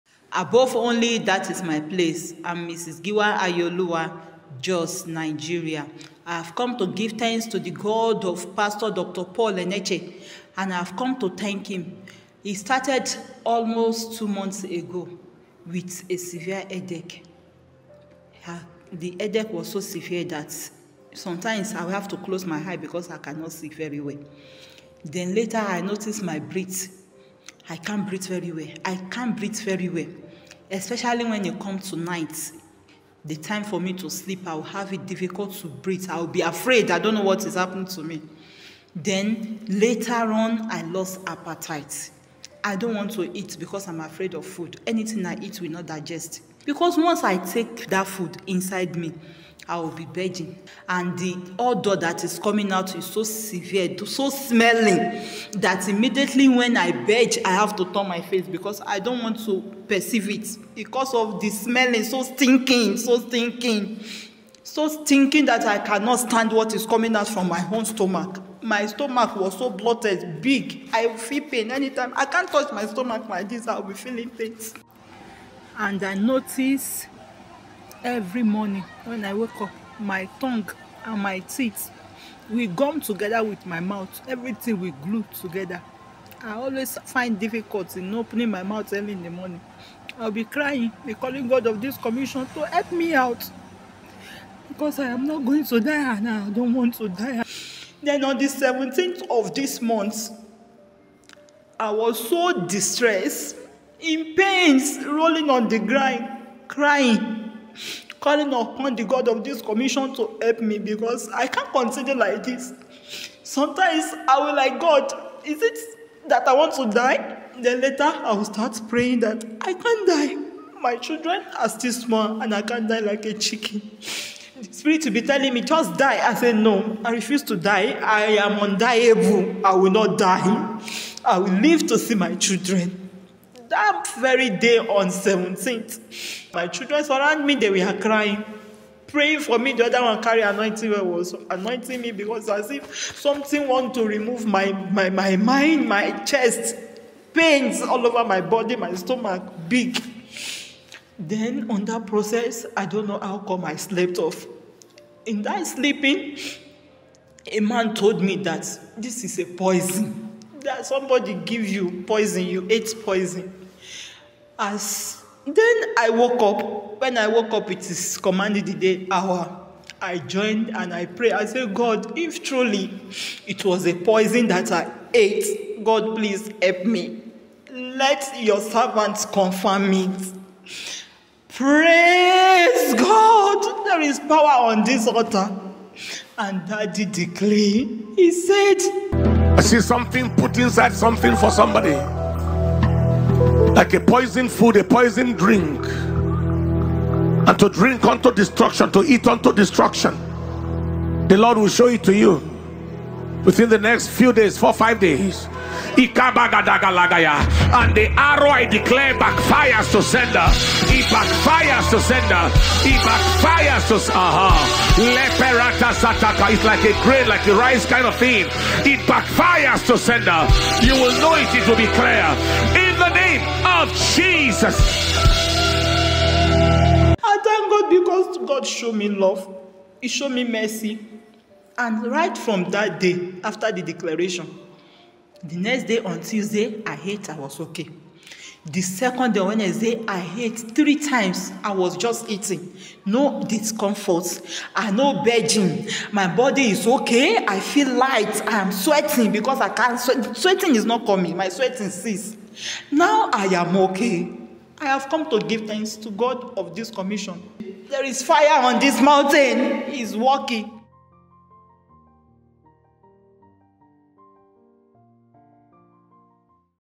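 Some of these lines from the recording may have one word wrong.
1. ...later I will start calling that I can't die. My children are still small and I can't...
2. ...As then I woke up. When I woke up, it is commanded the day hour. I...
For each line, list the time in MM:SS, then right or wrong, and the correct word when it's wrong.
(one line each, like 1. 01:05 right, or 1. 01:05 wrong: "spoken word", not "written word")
1. 01:57 wrong: "praying", not "calling"
2. 02:44 right.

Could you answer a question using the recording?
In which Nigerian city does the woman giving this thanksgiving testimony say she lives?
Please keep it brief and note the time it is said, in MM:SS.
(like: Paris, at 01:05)
Jos, at 00:04.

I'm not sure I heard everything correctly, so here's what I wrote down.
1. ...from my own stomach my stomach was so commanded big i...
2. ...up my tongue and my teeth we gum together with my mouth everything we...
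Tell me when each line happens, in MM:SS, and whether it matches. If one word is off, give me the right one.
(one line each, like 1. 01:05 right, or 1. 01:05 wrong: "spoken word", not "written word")
1. 01:07 wrong: "bloated", not "commanded"
2. 01:19 right.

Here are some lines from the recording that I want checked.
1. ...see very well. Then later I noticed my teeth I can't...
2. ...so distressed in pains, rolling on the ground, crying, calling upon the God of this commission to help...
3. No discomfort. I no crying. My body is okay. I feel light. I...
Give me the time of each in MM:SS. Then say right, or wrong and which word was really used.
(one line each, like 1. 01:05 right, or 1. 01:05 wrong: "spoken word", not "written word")
1. 00:23 wrong: "breath", not "teeth"
2. 01:42 right
3. 04:03 wrong: "begging", not "crying".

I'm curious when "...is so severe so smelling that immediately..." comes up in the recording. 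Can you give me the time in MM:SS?
00:52.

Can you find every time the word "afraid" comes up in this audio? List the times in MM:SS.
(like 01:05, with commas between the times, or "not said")
00:36, 00:44.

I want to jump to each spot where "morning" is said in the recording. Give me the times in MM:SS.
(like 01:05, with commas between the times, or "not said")
01:18, 01:29.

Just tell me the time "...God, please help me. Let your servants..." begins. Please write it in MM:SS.
02:55.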